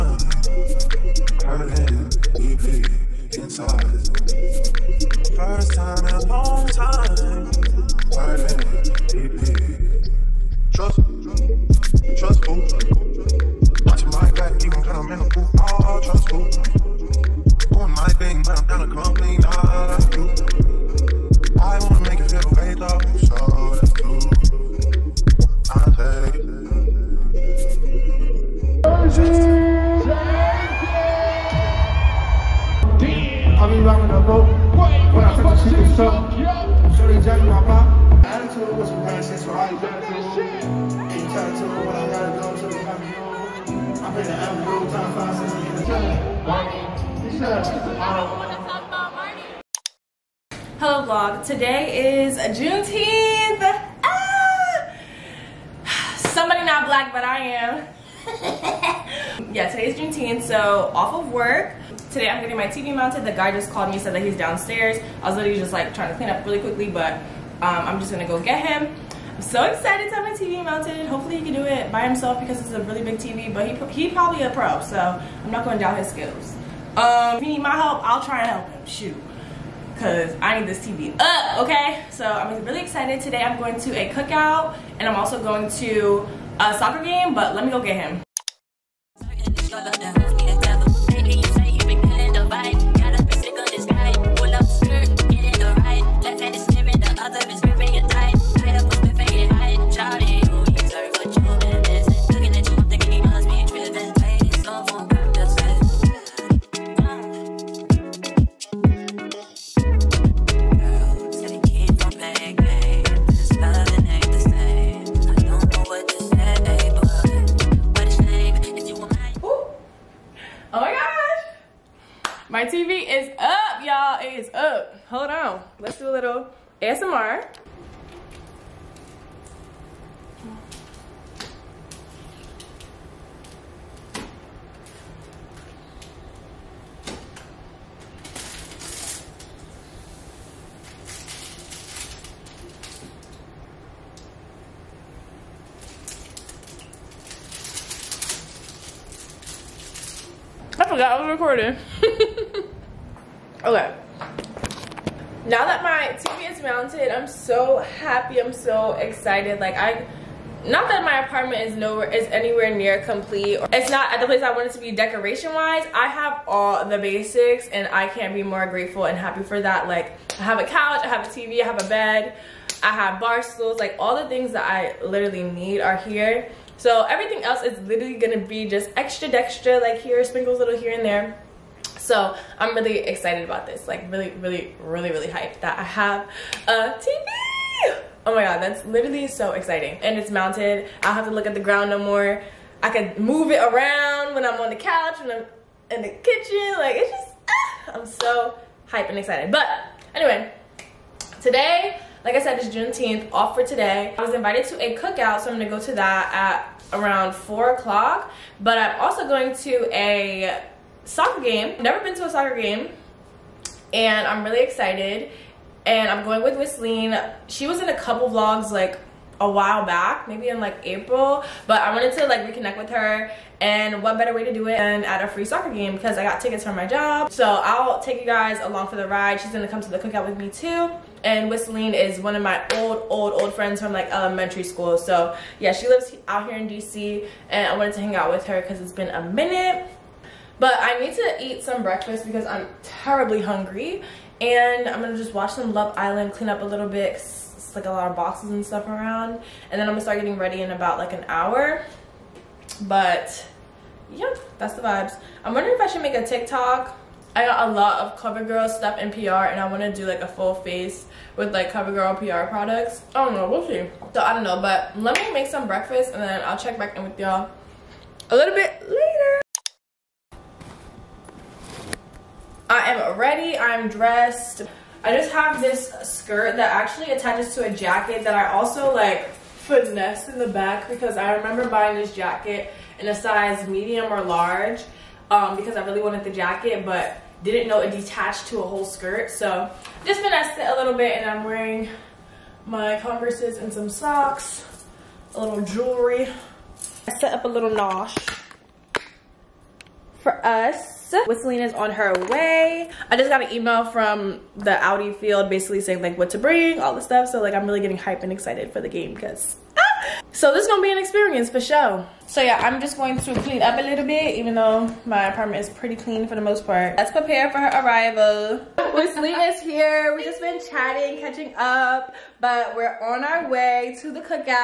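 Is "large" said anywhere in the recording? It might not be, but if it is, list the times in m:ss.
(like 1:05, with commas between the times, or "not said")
4:44.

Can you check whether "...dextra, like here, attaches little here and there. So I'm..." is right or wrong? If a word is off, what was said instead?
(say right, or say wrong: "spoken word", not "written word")
wrong: "sprinkles", not "attaches".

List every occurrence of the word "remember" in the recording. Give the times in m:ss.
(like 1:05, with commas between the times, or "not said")
4:41.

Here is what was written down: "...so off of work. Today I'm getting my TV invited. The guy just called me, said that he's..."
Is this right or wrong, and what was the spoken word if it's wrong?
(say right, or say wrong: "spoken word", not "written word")
wrong: "mounted", not "invited".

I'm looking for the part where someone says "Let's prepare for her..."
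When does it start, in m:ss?
5:16.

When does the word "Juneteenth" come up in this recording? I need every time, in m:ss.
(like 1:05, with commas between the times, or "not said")
0:52, 0:59, 3:22.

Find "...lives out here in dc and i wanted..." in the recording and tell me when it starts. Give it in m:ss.
3:55.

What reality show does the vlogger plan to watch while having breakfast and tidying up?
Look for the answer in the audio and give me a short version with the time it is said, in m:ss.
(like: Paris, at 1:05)
Love Island, at 4:05.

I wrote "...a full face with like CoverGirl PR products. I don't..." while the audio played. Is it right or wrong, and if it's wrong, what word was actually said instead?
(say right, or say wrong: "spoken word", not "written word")
right.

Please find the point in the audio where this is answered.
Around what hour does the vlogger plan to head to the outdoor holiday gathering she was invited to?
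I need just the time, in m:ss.
3:27.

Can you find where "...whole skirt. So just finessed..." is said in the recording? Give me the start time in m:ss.
4:48.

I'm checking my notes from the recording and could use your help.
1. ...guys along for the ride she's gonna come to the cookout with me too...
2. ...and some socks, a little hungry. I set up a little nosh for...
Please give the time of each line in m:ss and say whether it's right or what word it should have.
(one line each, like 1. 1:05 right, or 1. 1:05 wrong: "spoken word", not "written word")
1. 3:48 right
2. 4:53 wrong: "jewelry", not "hungry".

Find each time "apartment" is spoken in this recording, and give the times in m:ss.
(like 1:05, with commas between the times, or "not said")
2:41, 5:15.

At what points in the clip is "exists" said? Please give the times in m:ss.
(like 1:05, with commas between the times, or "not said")
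not said.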